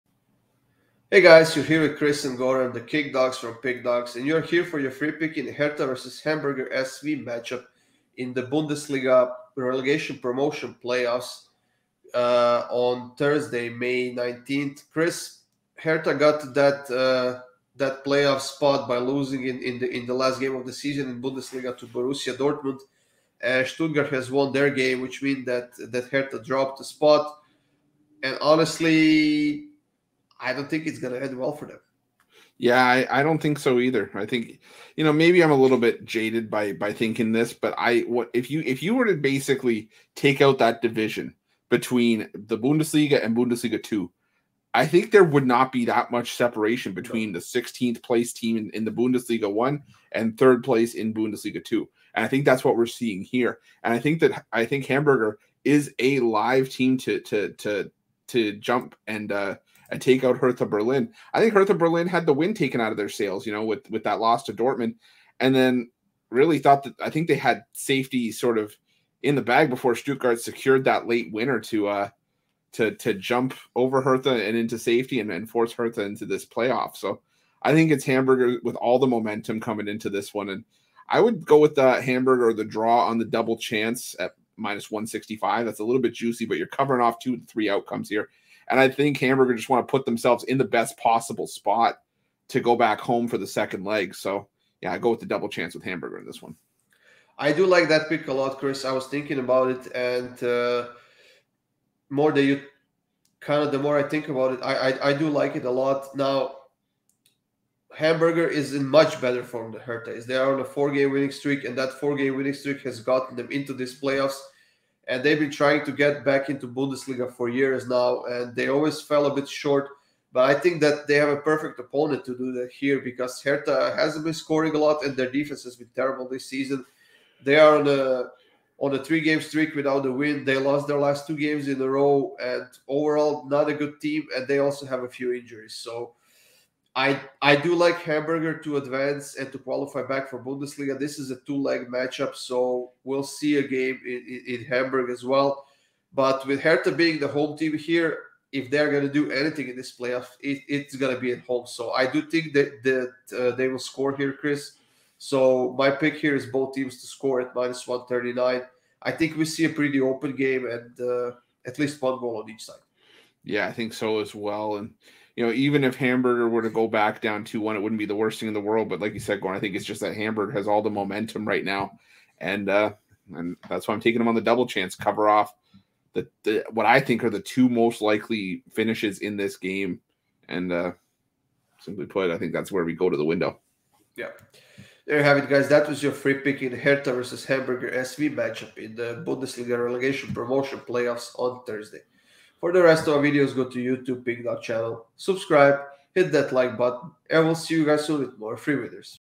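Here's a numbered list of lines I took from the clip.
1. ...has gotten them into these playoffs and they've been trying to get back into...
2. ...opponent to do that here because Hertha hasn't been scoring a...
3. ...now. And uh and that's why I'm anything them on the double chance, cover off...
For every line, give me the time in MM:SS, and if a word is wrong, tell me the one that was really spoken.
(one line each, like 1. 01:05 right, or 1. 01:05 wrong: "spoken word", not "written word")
1. 01:52 right
2. 02:01 right
3. 02:51 wrong: "taking", not "anything".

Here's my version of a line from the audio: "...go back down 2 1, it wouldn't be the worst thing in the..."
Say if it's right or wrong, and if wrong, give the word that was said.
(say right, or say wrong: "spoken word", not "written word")
right.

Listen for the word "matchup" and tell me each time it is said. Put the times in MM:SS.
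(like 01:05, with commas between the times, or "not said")
00:07, 02:21, 03:08.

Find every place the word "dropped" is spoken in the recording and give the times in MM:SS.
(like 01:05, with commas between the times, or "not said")
00:26.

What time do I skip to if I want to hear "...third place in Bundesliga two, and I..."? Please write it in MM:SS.
00:50.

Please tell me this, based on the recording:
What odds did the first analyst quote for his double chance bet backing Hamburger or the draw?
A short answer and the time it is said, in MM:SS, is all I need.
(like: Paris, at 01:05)
-165, at 01:24.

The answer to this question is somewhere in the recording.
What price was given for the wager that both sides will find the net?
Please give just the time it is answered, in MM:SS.
02:37.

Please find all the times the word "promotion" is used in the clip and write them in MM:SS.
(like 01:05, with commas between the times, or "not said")
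00:10, 03:10.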